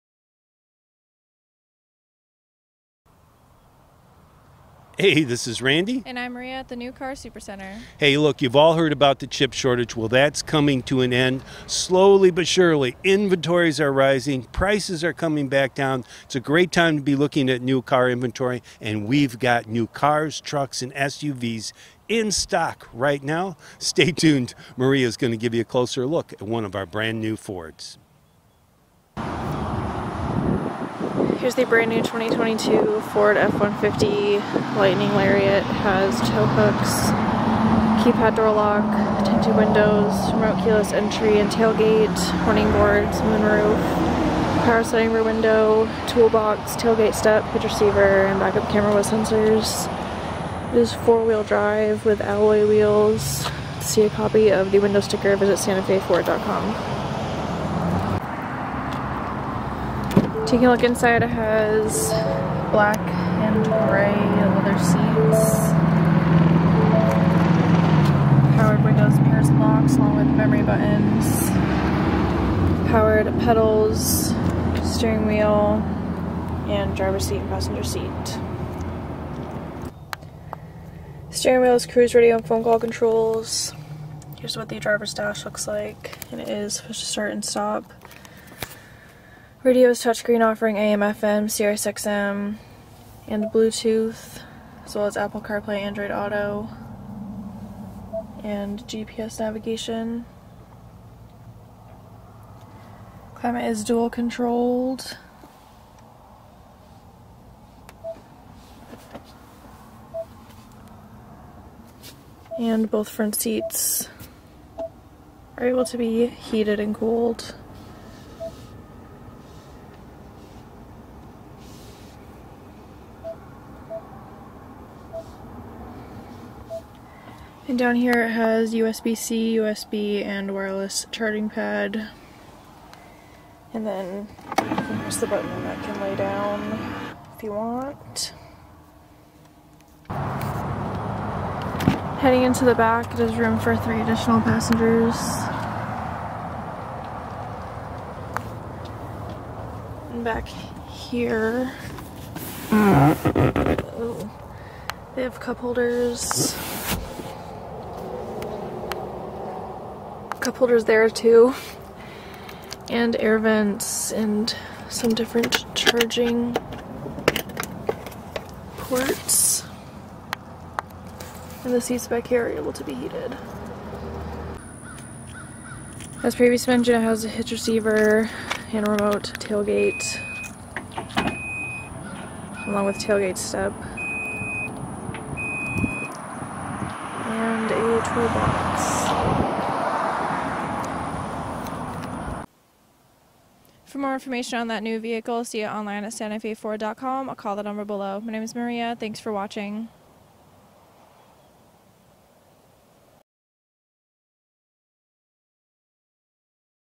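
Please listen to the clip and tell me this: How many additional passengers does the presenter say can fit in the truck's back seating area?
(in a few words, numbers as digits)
3.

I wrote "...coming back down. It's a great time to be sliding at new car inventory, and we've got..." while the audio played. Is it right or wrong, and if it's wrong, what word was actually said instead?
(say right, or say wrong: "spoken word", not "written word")
wrong: "looking", not "sliding".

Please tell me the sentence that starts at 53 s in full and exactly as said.
See a copy of the window sticker, visit santafeford.com.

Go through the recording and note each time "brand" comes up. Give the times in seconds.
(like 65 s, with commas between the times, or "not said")
26 s, 31 s.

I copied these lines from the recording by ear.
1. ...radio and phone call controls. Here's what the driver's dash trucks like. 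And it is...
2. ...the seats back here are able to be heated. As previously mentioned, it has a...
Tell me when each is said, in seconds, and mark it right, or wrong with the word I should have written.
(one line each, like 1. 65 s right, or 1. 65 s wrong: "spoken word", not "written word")
1. 82 s wrong: "looks", not "trucks"
2. 171 s right.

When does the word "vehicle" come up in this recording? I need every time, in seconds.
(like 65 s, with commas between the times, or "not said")
194 s.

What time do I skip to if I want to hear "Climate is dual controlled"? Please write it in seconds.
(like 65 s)
103 s.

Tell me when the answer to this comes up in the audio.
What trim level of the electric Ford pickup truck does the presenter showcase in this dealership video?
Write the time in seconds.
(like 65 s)
35 s.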